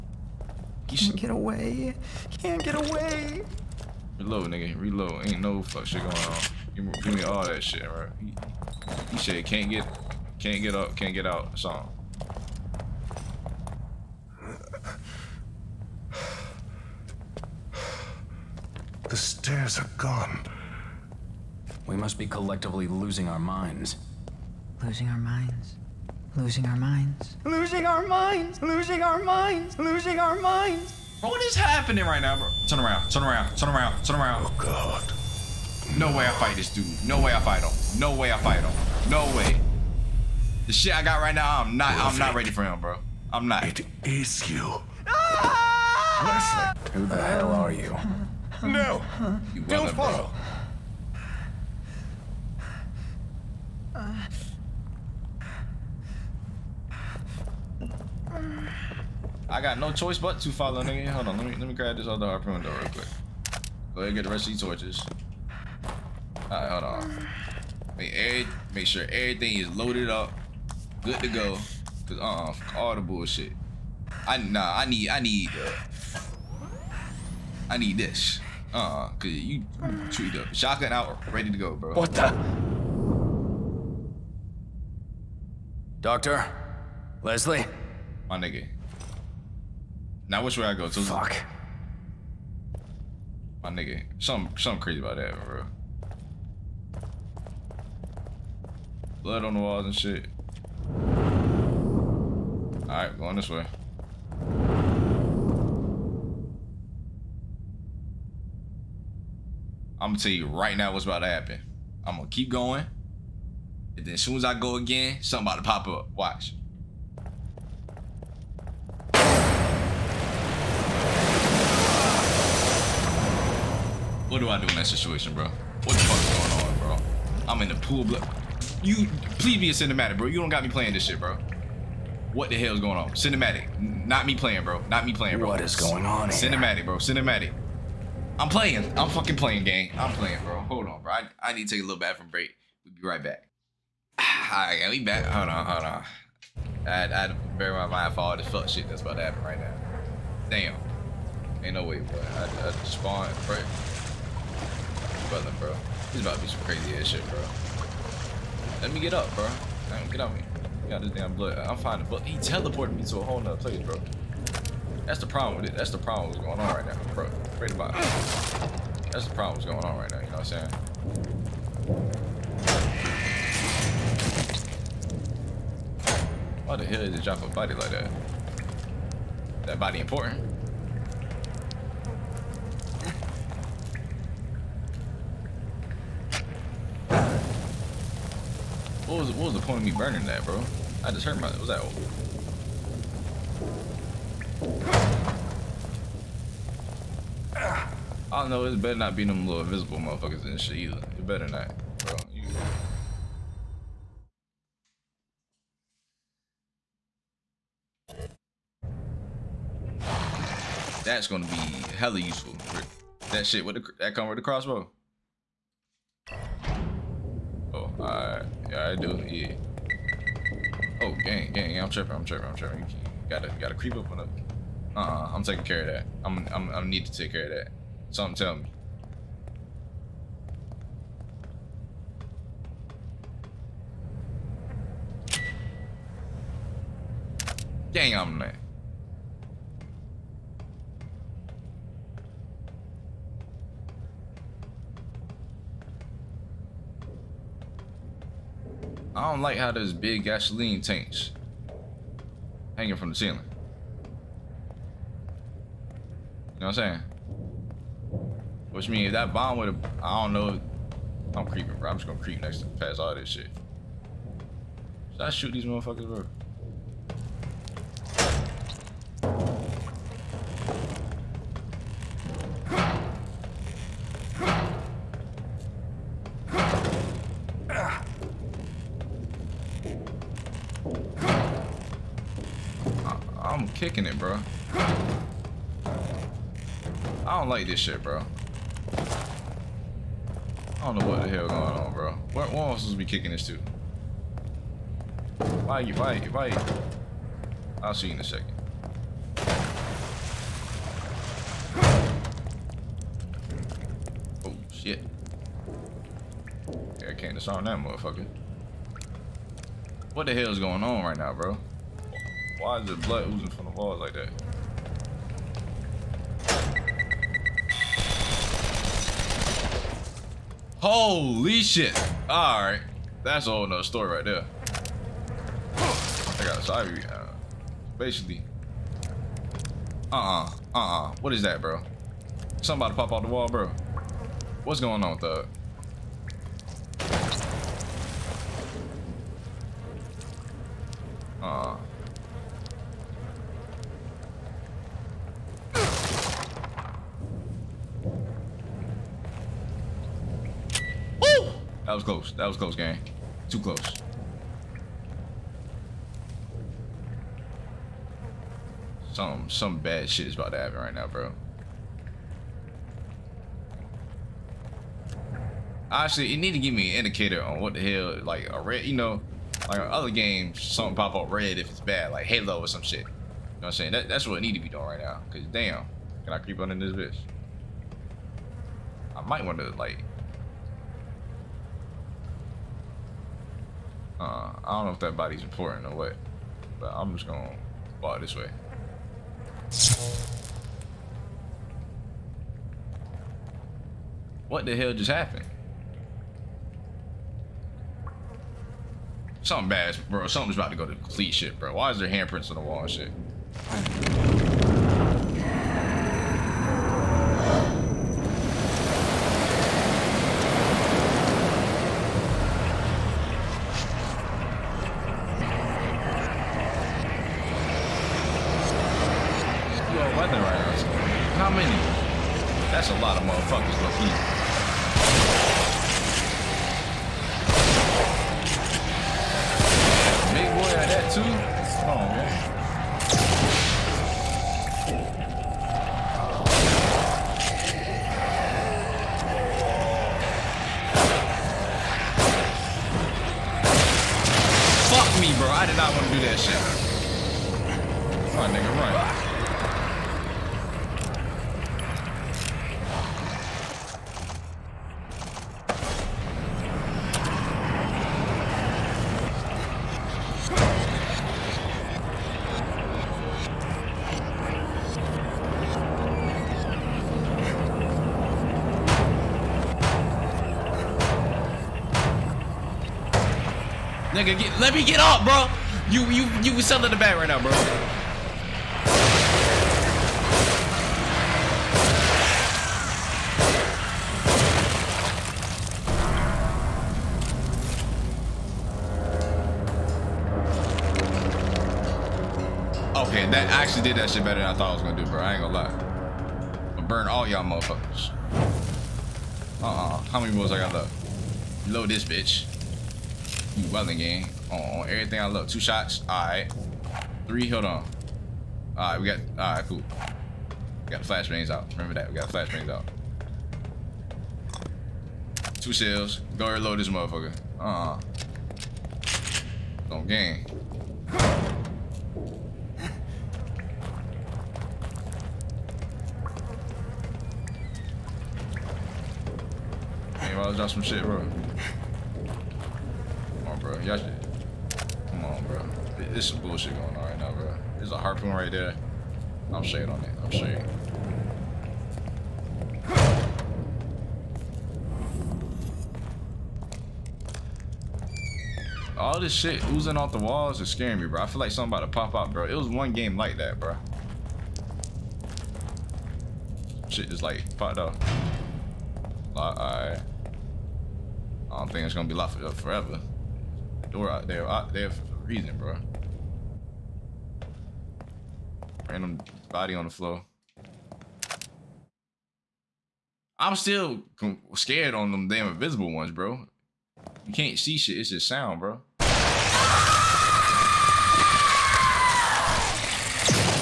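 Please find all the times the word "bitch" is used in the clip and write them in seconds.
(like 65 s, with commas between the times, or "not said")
376 s, 502 s.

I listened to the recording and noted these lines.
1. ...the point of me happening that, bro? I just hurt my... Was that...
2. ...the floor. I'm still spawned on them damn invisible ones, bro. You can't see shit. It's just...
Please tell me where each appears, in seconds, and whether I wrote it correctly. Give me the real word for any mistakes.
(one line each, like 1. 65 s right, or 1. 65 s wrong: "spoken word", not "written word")
1. 189 s wrong: "burning", not "happening"
2. 569 s wrong: "scared", not "spawned".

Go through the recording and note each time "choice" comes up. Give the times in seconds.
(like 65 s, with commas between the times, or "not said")
59 s.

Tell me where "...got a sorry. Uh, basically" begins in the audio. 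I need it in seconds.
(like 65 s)
326 s.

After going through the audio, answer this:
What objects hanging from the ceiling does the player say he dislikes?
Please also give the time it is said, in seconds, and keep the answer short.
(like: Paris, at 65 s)
gasoline tanks, at 250 s.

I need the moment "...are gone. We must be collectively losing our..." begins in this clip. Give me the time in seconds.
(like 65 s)
19 s.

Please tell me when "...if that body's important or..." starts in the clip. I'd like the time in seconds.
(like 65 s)
384 s.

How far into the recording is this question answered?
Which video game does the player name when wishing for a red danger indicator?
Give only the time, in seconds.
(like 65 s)
372 s.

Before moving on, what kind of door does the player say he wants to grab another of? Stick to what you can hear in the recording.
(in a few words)
harpoon door.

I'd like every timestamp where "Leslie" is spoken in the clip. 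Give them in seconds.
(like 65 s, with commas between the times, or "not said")
46 s, 87 s.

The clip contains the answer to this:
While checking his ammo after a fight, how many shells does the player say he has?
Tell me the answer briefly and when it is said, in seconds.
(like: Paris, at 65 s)
2, at 515 s.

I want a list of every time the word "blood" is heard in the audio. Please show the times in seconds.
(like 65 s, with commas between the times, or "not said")
99 s, 161 s, 312 s.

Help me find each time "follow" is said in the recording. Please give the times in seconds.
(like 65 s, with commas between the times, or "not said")
49 s, 60 s.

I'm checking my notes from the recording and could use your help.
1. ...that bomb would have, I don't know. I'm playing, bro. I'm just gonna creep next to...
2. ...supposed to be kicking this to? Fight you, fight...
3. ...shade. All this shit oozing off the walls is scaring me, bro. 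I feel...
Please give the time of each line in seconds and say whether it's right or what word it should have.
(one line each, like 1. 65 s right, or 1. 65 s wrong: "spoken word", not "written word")
1. 259 s wrong: "creeping", not "playing"
2. 292 s right
3. 540 s right.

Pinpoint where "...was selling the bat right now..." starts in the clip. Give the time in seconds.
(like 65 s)
476 s.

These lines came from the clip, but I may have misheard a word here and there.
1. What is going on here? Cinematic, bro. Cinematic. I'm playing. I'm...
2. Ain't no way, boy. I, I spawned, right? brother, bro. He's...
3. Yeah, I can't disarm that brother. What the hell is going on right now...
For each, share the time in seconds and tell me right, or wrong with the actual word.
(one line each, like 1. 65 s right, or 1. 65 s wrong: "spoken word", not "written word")
1. 135 s right
2. 151 s right
3. 307 s wrong: "motherfucker", not "brother".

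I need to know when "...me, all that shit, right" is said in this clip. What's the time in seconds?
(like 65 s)
7 s.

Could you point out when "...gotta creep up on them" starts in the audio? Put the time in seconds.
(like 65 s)
223 s.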